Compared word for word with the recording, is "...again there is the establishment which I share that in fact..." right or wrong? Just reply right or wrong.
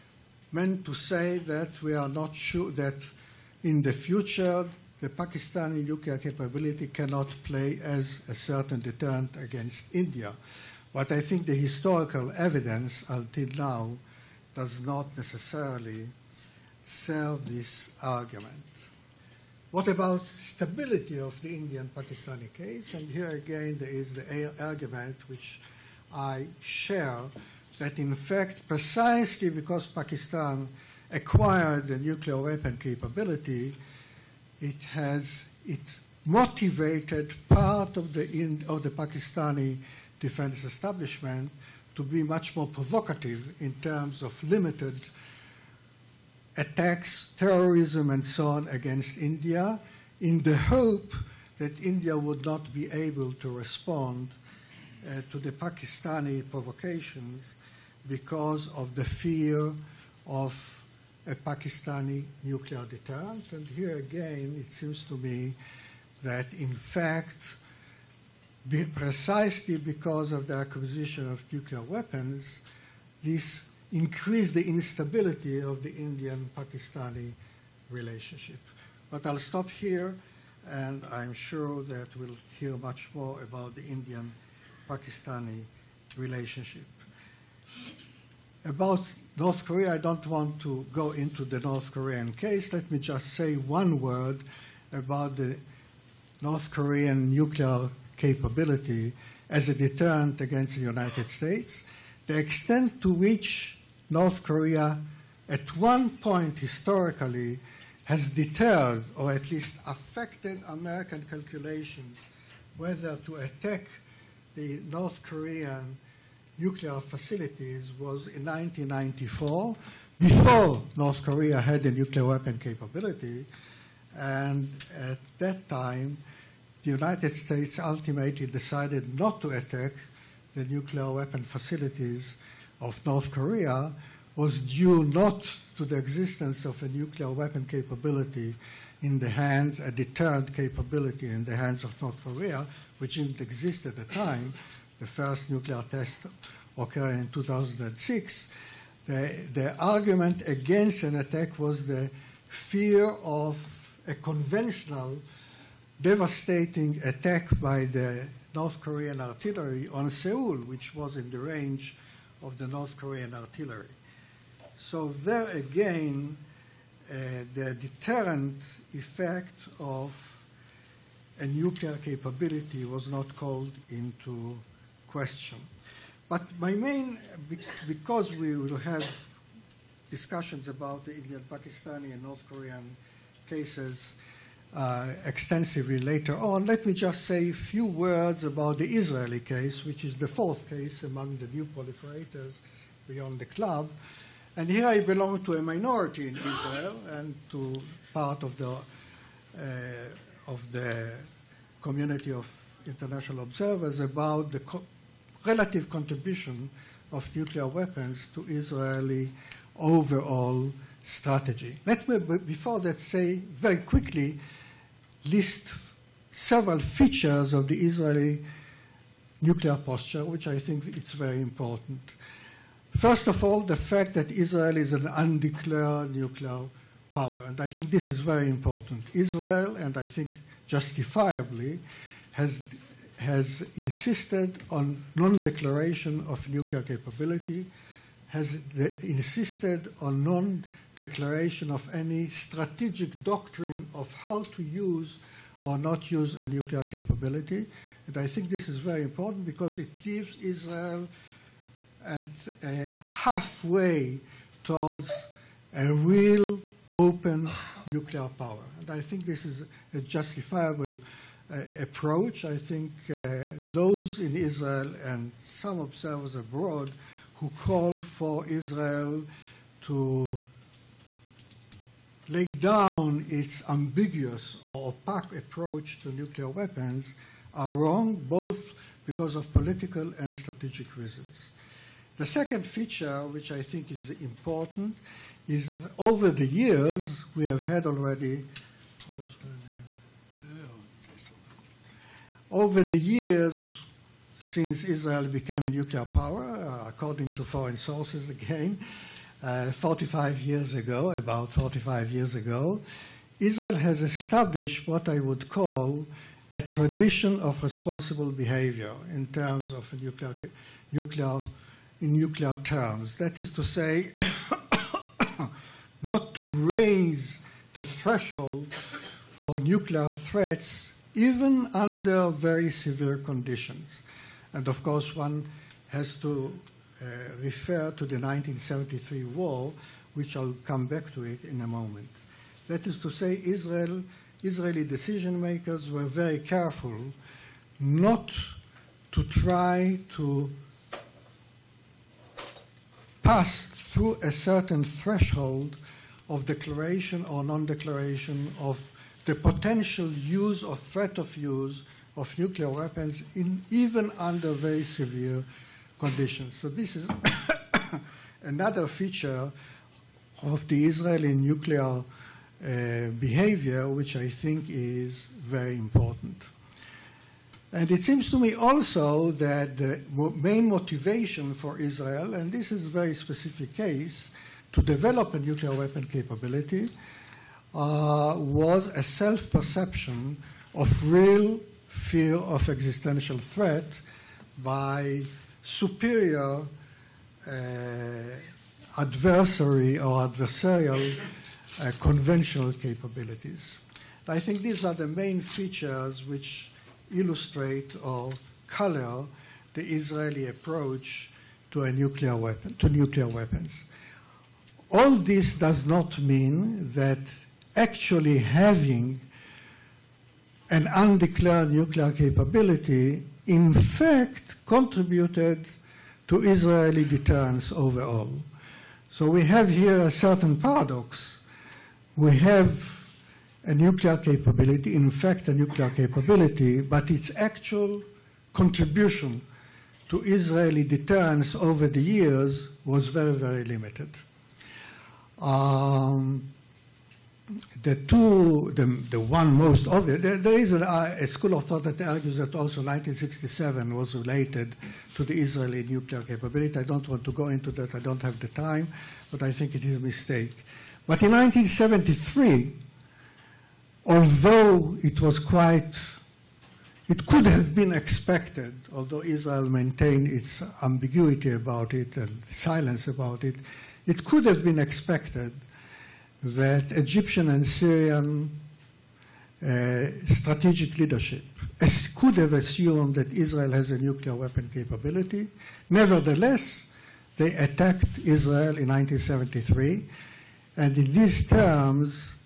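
wrong.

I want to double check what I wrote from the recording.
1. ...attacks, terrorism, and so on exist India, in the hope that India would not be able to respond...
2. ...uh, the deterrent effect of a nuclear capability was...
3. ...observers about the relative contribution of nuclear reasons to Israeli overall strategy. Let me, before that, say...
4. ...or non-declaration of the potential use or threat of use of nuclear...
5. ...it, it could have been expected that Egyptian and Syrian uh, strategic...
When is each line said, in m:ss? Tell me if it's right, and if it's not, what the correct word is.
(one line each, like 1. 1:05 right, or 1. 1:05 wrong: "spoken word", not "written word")
1. 0:46 wrong: "against", not "exist"
2. 2:47 right
3. 3:23 wrong: "weapons", not "reasons"
4. 5:47 right
5. 7:43 right.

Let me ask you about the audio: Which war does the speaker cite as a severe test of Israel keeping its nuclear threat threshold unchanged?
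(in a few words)
1973 war.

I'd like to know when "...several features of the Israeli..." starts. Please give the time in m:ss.
3:36.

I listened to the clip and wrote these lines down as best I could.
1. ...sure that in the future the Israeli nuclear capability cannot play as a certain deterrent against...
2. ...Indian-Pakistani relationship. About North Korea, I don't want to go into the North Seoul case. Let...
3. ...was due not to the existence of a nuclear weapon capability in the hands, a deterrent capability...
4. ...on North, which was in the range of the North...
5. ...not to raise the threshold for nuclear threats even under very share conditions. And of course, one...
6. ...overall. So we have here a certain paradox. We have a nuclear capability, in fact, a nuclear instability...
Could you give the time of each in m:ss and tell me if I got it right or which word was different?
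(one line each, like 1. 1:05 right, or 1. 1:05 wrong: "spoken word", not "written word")
1. 0:02 wrong: "Pakistani", not "Israeli"
2. 1:23 wrong: "Korean", not "Seoul"
3. 2:14 right
4. 2:39 wrong: "Seoul", not "North"
5. 5:16 wrong: "severe", not "share"
6. 6:57 wrong: "capability", not "instability".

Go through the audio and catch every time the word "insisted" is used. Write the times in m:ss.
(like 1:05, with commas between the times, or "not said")
3:53, 3:59.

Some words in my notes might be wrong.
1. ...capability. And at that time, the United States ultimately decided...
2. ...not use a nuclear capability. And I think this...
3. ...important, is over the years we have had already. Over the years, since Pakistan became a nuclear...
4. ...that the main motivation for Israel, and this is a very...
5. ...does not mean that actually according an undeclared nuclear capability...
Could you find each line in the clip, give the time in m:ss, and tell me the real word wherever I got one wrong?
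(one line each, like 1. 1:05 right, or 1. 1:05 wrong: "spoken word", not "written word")
1. 2:02 right
2. 4:05 right
3. 4:44 wrong: "Israel", not "Pakistan"
4. 6:09 right
5. 6:45 wrong: "having", not "according".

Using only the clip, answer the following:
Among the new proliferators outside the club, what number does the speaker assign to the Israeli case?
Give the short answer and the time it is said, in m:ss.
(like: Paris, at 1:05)
fourth, at 3:10.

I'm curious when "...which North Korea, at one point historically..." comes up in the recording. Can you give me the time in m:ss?
1:43.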